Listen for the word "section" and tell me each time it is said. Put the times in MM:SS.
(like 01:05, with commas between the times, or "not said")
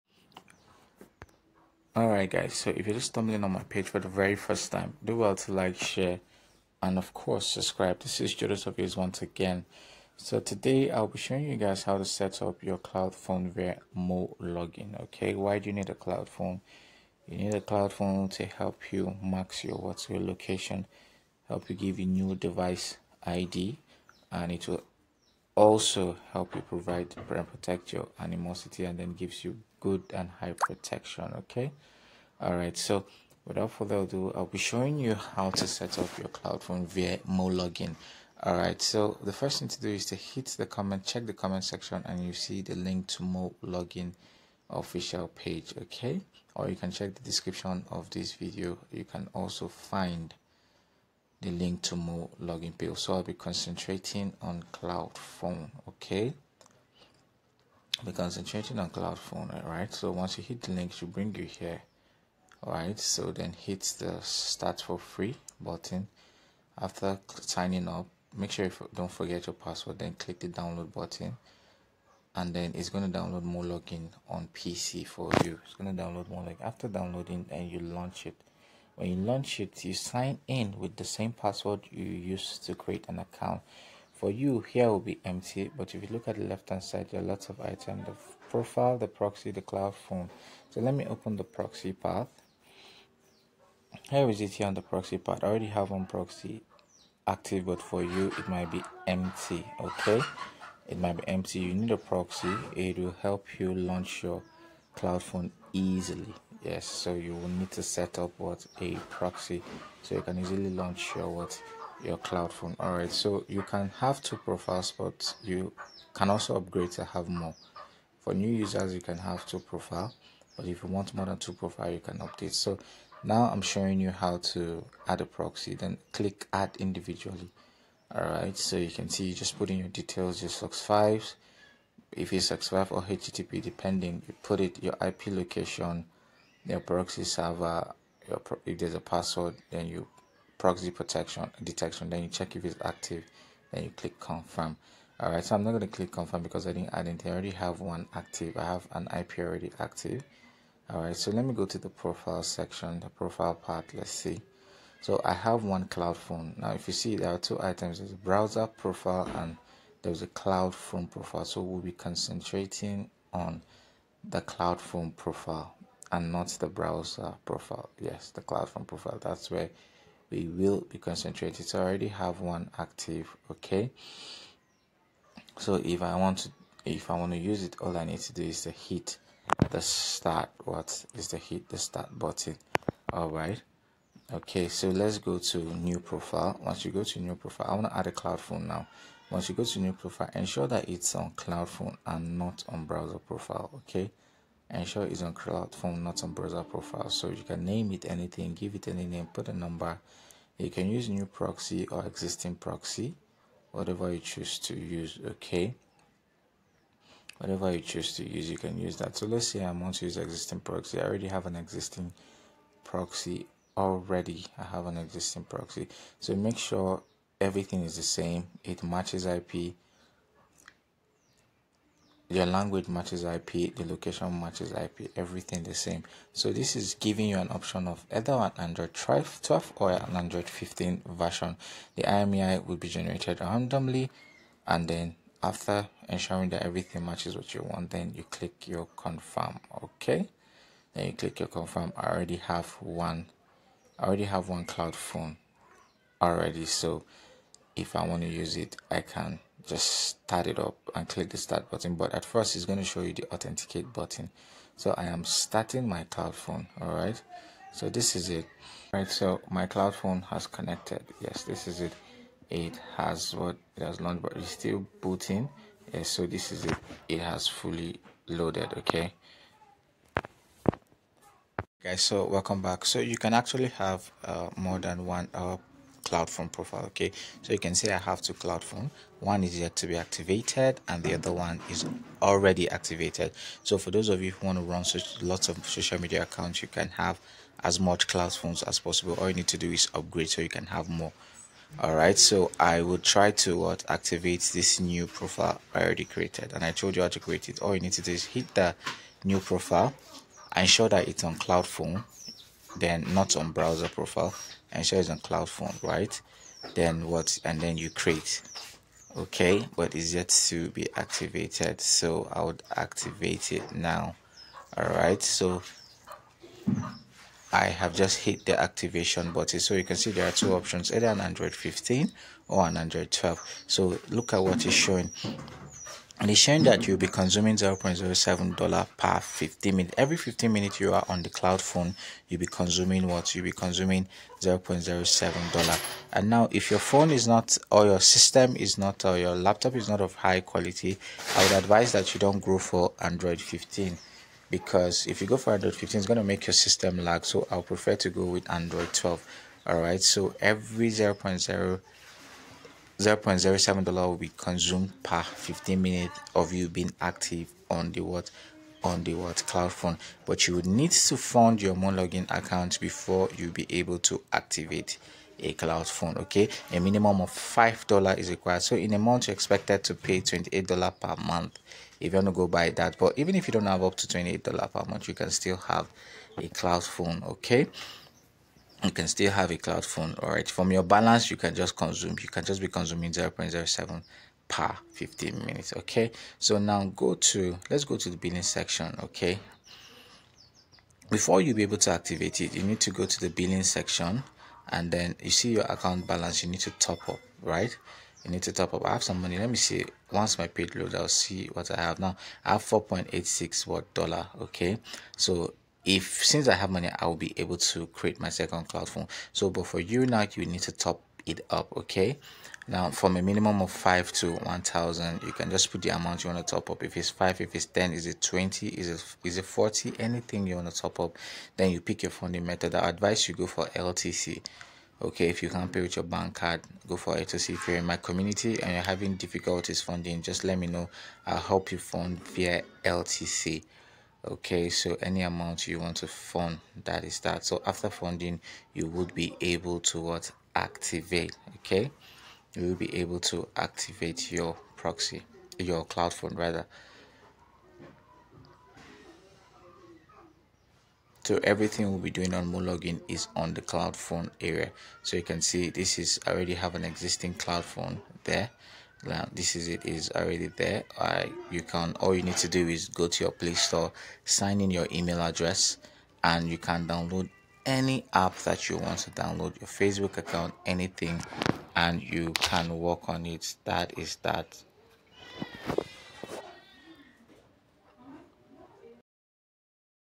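00:41, 02:32, 06:28, 06:33.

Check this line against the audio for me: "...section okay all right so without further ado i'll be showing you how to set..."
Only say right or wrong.
wrong.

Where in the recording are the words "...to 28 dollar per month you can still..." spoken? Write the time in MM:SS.
06:13.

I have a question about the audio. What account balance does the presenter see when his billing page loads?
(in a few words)
$4.86.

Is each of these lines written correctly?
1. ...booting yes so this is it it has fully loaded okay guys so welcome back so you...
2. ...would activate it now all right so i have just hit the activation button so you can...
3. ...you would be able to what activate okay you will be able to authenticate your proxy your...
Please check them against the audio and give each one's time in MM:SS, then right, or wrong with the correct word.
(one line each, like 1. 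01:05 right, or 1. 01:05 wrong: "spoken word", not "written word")
1. 04:25 right
2. 05:12 right
3. 07:18 wrong: "activate", not "authenticate".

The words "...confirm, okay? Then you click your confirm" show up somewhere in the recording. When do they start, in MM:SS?
03:58.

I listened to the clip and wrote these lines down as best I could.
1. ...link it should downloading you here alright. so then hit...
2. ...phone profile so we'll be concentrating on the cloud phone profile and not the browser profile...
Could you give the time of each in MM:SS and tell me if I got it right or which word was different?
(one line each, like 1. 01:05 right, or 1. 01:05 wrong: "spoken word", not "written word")
1. 01:00 wrong: "bring", not "downloading"
2. 02:40 right.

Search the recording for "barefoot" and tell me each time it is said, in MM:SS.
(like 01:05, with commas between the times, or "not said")
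not said.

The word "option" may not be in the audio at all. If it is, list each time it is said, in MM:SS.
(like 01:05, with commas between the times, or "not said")
03:47, 05:20.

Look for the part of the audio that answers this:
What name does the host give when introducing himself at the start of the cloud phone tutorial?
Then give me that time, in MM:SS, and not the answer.
00:08.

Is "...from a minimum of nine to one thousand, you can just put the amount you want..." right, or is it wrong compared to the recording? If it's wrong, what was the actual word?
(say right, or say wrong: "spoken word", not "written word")
wrong: "five", not "nine".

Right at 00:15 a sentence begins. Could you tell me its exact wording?
Okay, why do you need a cloud phone?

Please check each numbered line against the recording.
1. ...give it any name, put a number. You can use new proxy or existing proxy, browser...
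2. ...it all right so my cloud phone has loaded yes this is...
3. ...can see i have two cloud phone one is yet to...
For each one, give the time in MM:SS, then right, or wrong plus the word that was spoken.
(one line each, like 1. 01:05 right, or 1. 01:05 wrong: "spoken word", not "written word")
1. 03:18 wrong: "whatever", not "browser"
2. 04:18 wrong: "connected", not "loaded"
3. 04:37 right.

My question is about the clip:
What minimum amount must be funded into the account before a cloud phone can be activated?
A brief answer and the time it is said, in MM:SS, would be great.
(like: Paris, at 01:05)
$5, at 06:07.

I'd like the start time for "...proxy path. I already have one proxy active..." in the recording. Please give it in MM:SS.
01:34.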